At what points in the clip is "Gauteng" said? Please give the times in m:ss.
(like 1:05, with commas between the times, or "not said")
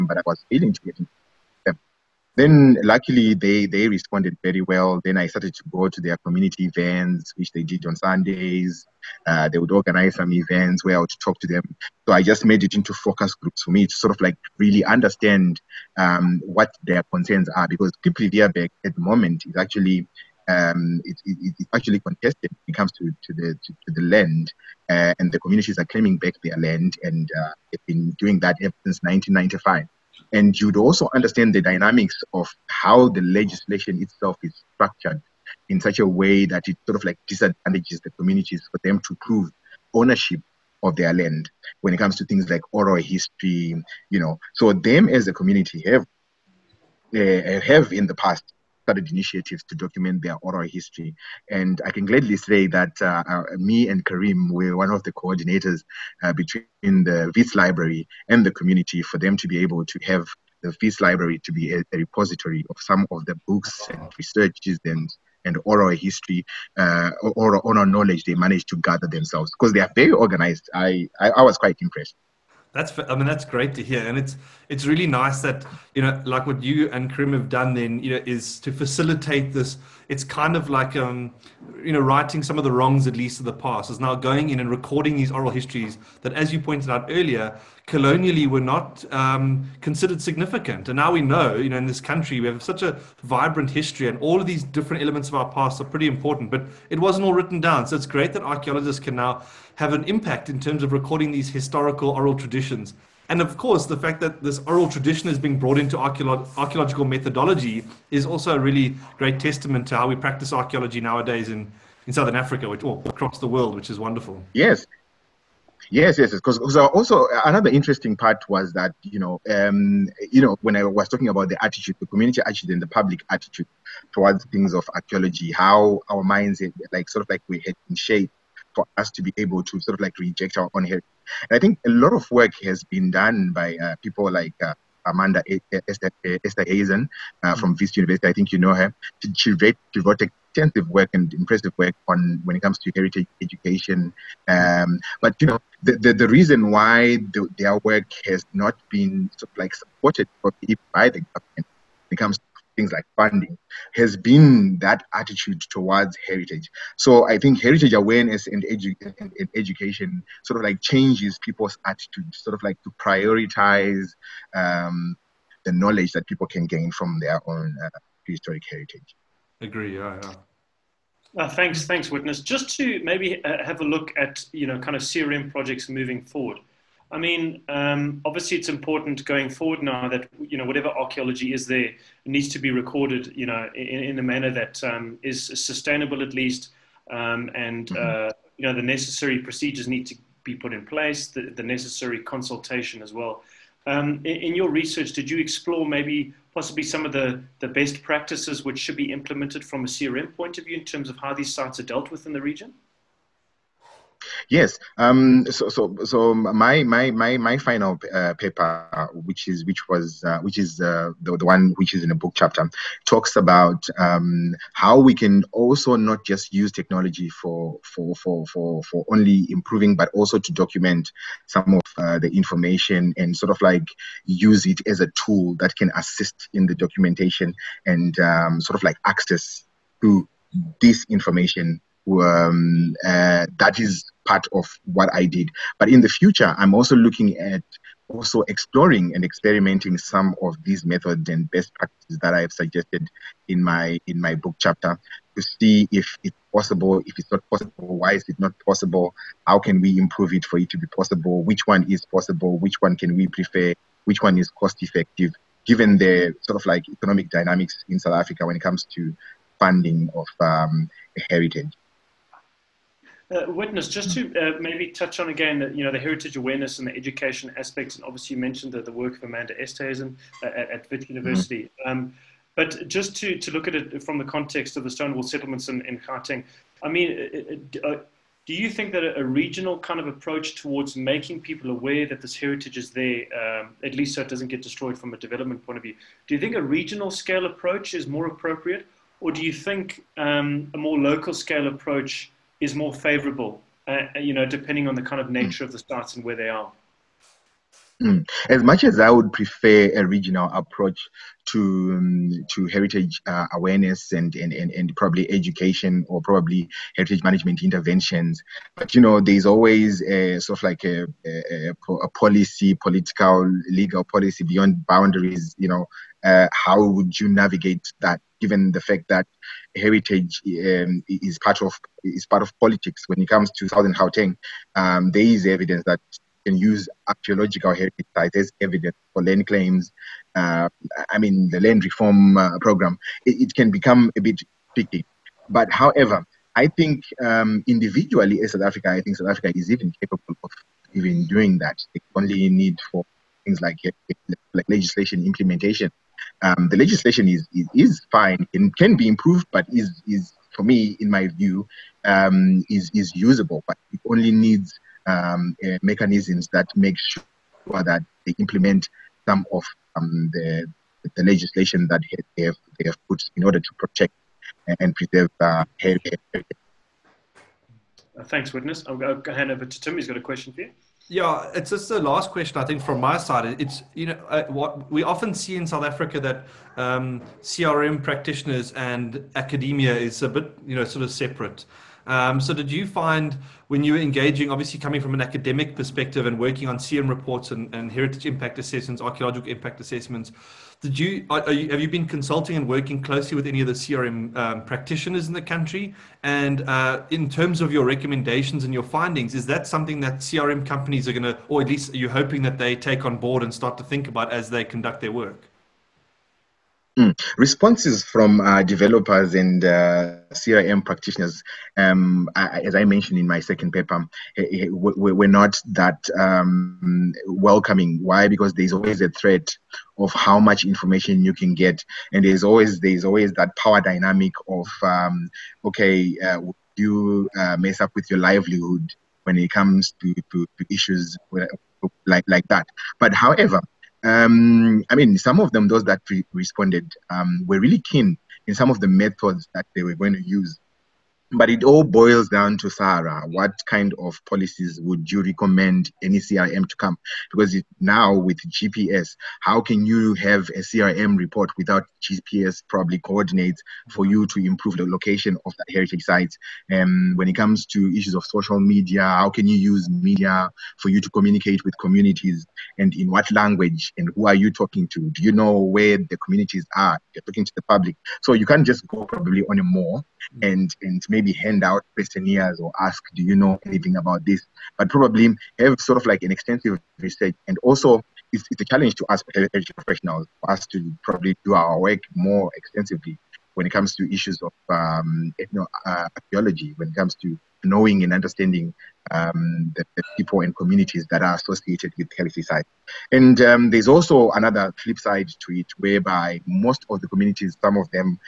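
4:35, 5:23.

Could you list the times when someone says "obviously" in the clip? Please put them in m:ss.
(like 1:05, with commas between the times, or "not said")
2:58, 4:28, 6:24.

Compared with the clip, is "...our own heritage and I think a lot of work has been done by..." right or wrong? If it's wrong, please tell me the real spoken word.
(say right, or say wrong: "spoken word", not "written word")
right.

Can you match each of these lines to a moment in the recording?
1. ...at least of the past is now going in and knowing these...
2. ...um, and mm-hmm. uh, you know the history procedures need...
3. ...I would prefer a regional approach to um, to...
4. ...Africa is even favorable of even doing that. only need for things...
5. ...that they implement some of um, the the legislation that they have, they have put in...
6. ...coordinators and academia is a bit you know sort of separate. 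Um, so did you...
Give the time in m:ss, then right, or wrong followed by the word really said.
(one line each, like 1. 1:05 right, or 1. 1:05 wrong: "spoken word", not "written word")
1. 1:23 wrong: "recording", not "knowing"
2. 3:07 wrong: "necessary", not "history"
3. 4:58 right
4. 5:39 wrong: "capable", not "favorable"
5. 5:57 right
6. 6:18 wrong: "practitioners", not "coordinators".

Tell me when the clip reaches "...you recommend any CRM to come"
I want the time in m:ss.
7:25.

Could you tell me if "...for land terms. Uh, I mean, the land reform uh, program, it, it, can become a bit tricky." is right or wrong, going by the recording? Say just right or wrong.
wrong.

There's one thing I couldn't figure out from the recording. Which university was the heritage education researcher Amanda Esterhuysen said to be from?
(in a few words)
Vista University.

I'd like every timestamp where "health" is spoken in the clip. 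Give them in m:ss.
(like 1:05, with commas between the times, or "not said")
6:05, 7:59.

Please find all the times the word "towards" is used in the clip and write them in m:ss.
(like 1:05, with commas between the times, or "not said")
2:04, 2:35, 4:40.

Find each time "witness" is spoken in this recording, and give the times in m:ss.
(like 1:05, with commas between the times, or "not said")
2:52, 4:23, 6:08.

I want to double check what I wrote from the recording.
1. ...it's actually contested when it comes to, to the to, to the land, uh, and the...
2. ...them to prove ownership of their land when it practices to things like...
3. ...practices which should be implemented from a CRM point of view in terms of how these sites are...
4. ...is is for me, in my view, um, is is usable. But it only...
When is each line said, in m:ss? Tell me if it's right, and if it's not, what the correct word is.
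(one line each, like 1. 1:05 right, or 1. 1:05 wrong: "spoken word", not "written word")
1. 0:21 right
2. 0:38 wrong: "comes", not "practices"
3. 3:18 right
4. 5:49 right.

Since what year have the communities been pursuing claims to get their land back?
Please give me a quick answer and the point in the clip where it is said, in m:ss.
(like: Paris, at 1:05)
1995, at 0:29.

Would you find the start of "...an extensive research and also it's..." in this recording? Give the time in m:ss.
7:56.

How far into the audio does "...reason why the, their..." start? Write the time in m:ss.
2:26.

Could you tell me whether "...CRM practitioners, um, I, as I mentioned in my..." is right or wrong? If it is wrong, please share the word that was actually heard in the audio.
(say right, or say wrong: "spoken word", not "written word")
right.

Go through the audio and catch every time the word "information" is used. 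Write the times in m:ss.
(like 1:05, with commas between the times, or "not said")
3:42, 3:51, 7:00.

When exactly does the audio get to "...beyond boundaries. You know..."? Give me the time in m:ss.
5:14.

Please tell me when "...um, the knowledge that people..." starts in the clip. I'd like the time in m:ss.
2:44.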